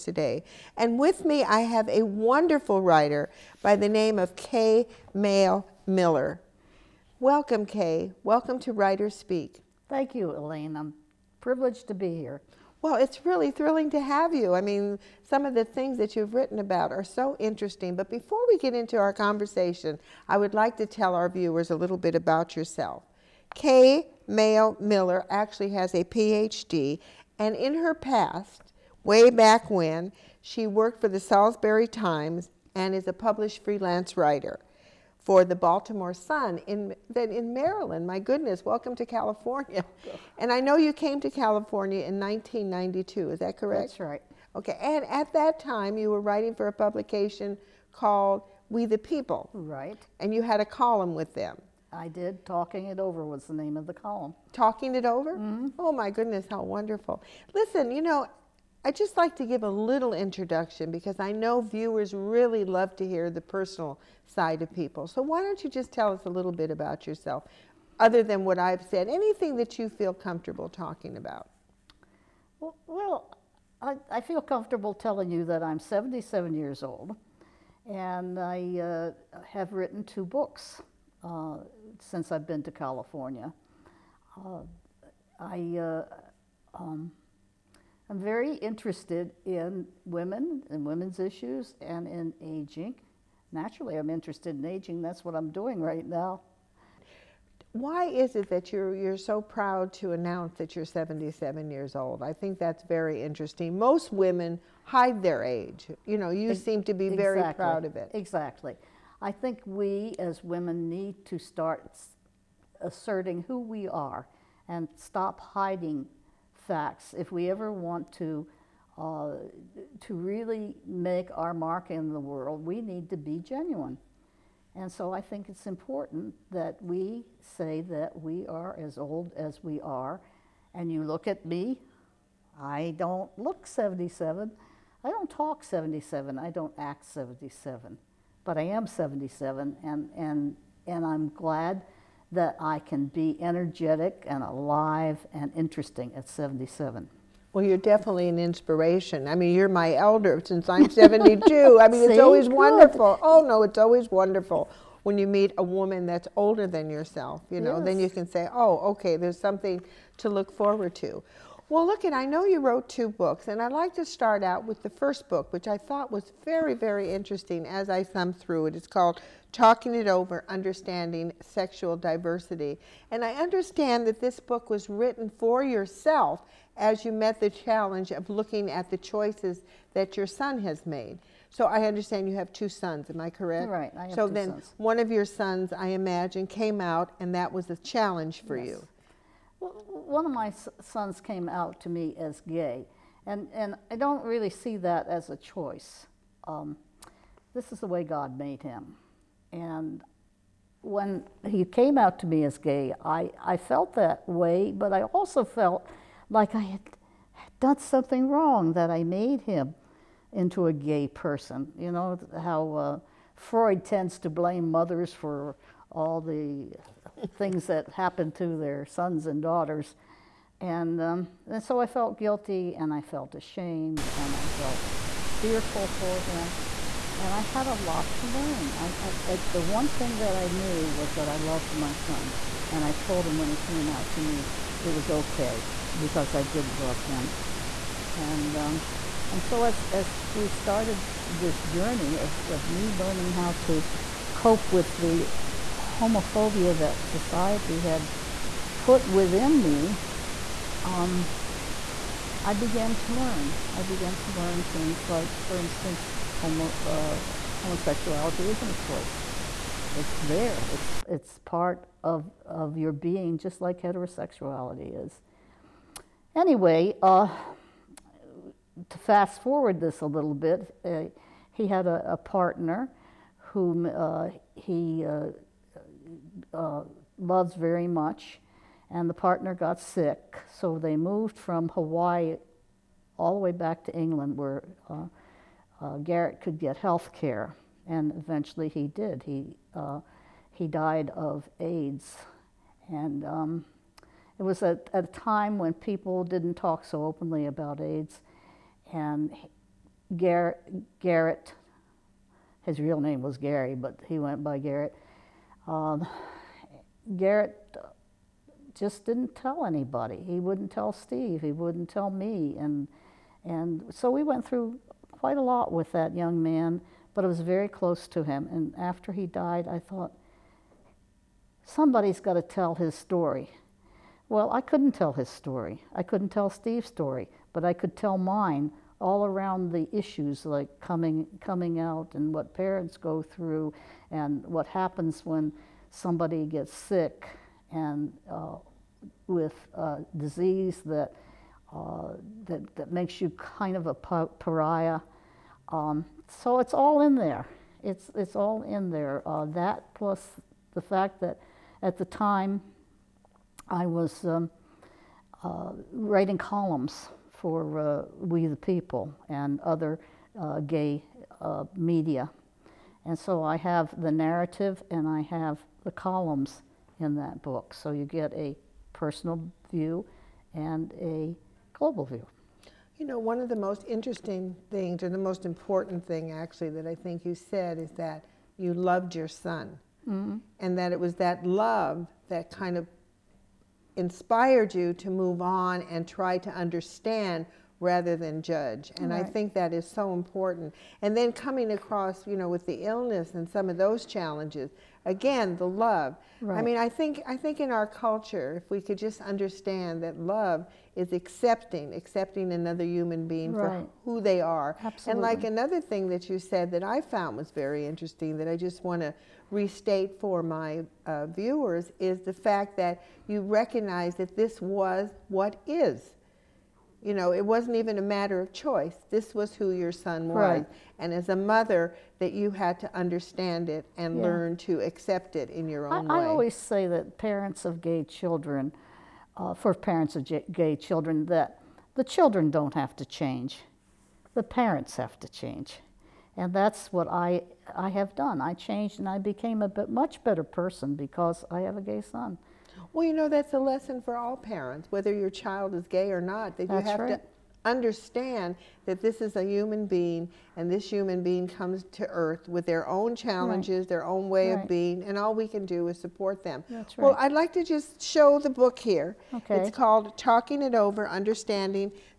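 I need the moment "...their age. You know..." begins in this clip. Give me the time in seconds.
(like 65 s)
105 s.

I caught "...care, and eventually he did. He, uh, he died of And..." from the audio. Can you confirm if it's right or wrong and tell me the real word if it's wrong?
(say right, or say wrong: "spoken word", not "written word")
wrong: "AIDS", not "And".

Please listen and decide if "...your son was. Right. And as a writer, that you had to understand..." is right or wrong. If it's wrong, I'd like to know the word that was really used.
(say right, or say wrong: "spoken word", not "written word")
wrong: "mother", not "writer".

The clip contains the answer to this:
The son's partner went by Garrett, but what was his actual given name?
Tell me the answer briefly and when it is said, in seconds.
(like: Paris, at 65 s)
Gary, at 303 s.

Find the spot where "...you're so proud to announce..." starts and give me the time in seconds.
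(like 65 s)
98 s.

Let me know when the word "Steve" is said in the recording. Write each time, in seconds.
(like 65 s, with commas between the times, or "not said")
310 s, 326 s.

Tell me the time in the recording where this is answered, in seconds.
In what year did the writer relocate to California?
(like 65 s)
42 s.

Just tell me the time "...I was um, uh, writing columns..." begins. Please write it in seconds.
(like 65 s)
353 s.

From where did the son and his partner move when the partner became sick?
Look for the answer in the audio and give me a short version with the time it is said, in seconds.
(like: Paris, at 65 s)
Hawaii, at 281 s.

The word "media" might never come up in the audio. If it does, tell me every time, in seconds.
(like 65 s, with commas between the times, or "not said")
361 s.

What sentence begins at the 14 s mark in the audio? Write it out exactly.
I mean, some of the things that you've written about are so interesting.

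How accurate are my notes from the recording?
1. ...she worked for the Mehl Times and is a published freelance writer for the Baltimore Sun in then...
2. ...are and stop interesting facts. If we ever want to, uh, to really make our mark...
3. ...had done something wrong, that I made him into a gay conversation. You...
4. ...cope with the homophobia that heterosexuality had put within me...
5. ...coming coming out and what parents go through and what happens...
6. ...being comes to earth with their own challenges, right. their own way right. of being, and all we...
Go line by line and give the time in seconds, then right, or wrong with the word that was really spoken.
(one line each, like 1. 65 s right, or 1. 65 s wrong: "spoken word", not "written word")
1. 30 s wrong: "Salisbury", not "Mehl"
2. 113 s wrong: "hiding", not "interesting"
3. 206 s wrong: "person", not "conversation"
4. 244 s wrong: "society", not "heterosexuality"
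5. 330 s right
6. 451 s right.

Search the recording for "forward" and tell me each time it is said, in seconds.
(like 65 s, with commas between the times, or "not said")
160 s, 269 s.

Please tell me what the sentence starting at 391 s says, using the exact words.
And then coming across, you know, with the illness and some of those challenges, again, the love.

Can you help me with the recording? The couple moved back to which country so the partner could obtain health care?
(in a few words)
England.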